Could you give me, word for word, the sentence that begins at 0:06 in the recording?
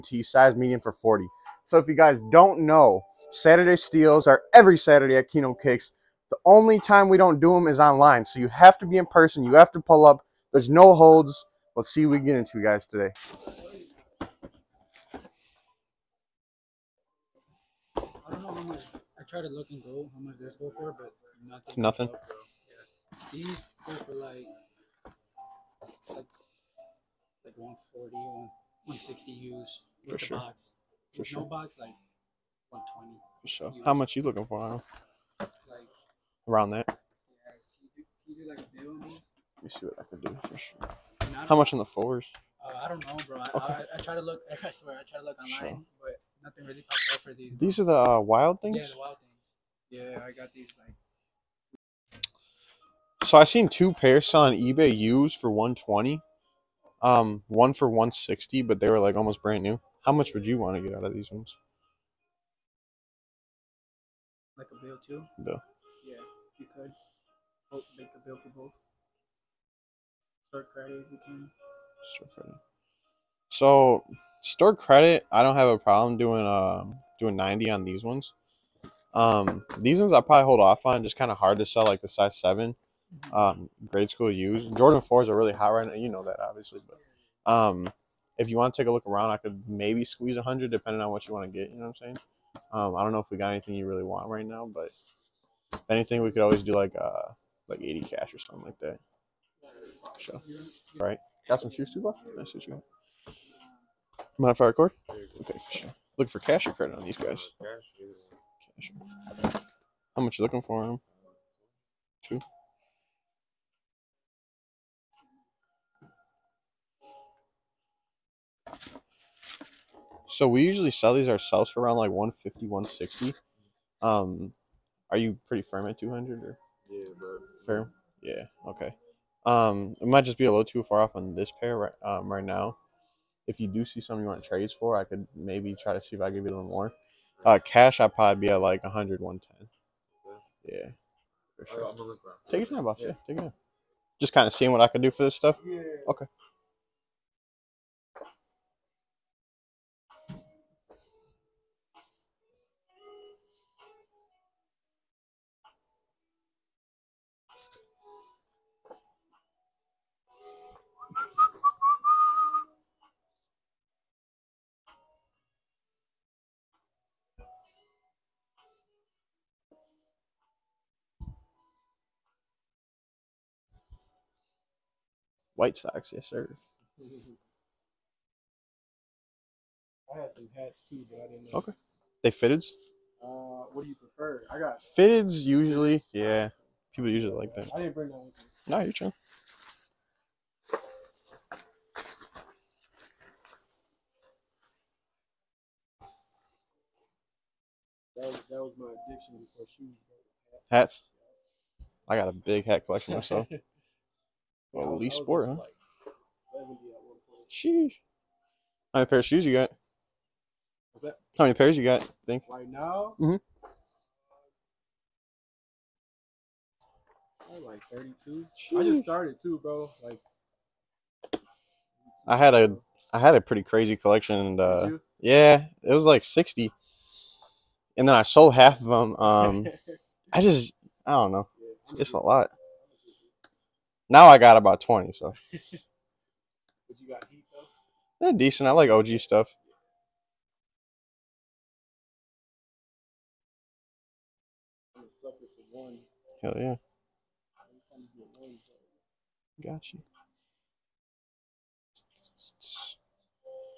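The only time we don't do them is online.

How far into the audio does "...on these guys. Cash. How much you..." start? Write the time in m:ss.
1:46.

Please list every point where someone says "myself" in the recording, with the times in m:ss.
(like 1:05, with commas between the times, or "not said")
3:23.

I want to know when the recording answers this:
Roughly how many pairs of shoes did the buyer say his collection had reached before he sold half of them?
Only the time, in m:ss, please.
3:46.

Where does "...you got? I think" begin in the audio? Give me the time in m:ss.
3:31.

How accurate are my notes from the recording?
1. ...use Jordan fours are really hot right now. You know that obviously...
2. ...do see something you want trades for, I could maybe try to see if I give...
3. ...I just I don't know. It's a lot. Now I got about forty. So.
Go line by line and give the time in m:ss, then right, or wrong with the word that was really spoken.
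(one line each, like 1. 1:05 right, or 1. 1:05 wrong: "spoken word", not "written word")
1. 1:24 right
2. 2:13 right
3. 3:50 wrong: "twenty", not "forty".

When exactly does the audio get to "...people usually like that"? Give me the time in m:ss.
3:06.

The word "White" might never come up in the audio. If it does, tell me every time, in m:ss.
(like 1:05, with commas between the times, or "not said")
2:55.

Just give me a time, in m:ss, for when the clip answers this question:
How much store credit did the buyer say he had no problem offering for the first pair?
1:17.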